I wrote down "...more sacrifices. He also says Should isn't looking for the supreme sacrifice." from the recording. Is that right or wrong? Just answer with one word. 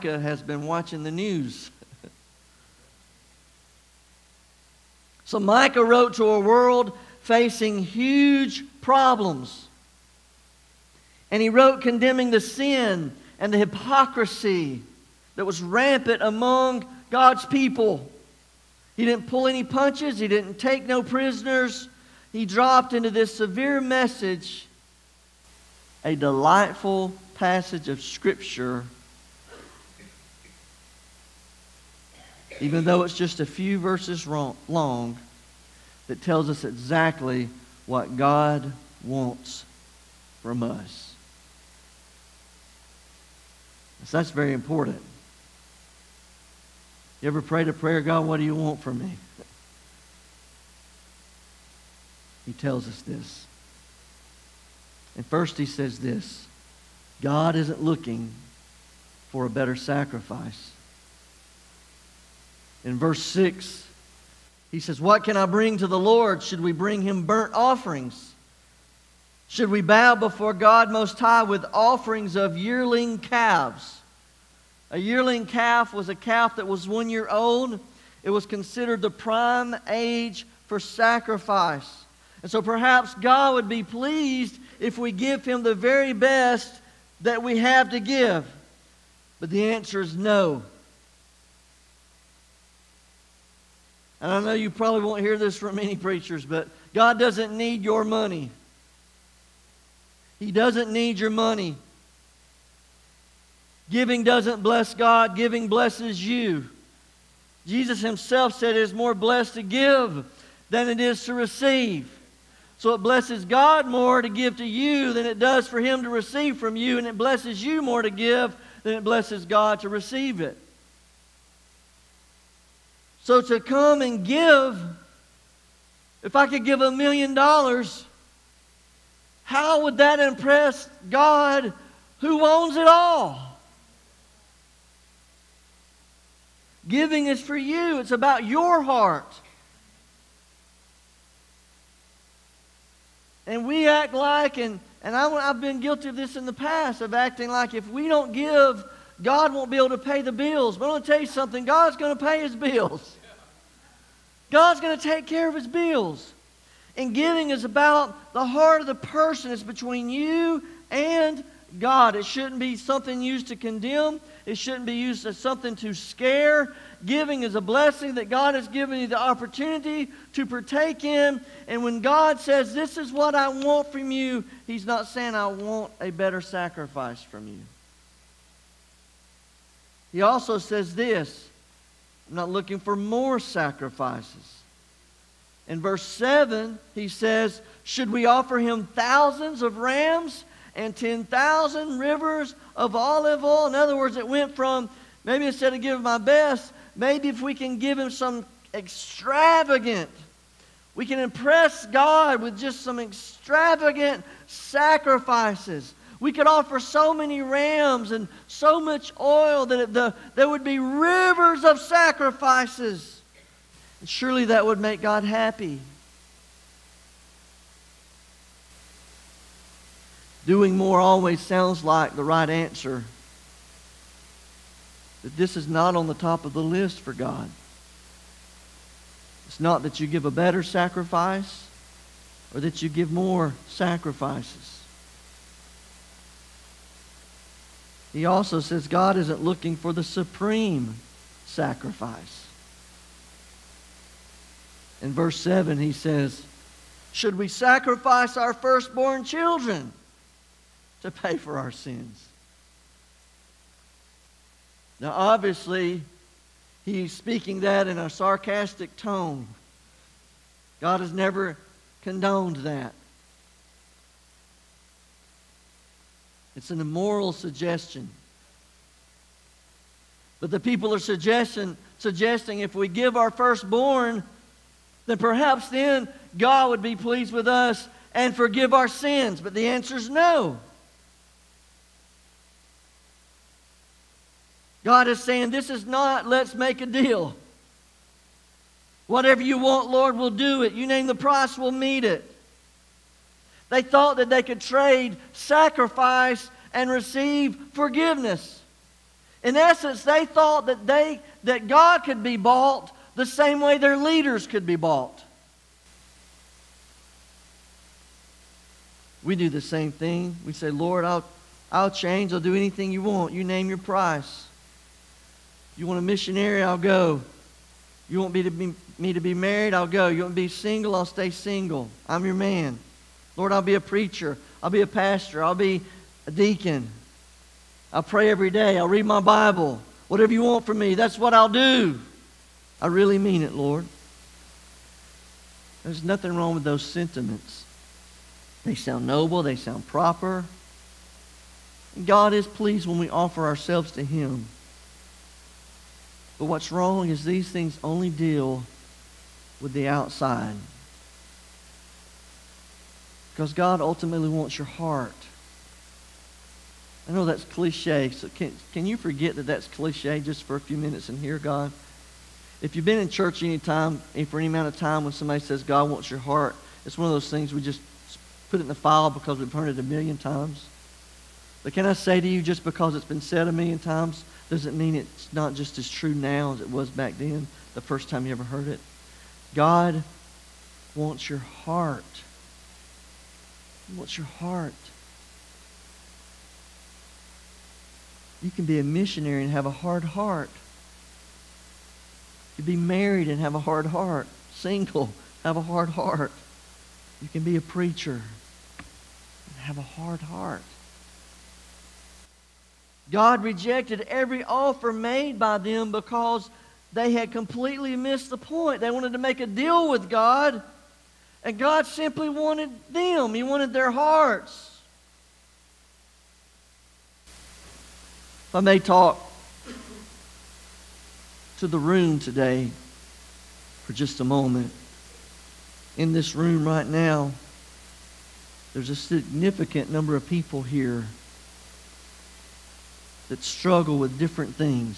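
wrong.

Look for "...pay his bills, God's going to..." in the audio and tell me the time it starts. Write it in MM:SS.
02:32.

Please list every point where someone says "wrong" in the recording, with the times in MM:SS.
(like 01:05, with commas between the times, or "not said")
05:36, 05:46.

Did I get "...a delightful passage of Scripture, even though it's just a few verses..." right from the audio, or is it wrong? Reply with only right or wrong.
right.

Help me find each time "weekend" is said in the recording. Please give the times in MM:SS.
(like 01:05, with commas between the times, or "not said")
not said.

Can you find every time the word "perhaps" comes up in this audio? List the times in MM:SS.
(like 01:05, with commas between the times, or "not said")
01:22, 04:35.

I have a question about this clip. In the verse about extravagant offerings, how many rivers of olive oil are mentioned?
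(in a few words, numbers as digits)
10,000.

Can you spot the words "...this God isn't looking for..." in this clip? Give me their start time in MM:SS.
00:55.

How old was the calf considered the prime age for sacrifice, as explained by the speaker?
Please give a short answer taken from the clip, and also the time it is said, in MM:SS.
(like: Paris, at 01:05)
1 year old, at 01:16.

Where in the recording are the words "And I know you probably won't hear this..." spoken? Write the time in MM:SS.
01:34.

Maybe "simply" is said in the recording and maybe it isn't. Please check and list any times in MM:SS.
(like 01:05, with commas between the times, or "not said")
06:51.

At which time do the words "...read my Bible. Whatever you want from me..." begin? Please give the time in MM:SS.
05:28.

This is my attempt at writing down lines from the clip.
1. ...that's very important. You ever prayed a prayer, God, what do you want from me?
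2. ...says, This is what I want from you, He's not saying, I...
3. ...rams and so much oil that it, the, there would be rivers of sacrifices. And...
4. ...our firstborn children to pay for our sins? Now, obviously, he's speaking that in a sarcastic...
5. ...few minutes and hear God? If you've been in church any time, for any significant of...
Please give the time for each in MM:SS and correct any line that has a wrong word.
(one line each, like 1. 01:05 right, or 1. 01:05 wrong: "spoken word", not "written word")
1. 00:44 right
2. 02:52 right
3. 03:27 right
4. 04:08 right
5. 06:00 wrong: "amount", not "significant".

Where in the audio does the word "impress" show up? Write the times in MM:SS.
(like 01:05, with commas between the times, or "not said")
02:10, 03:21.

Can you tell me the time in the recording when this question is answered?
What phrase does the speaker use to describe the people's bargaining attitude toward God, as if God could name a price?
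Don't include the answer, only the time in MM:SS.
04:46.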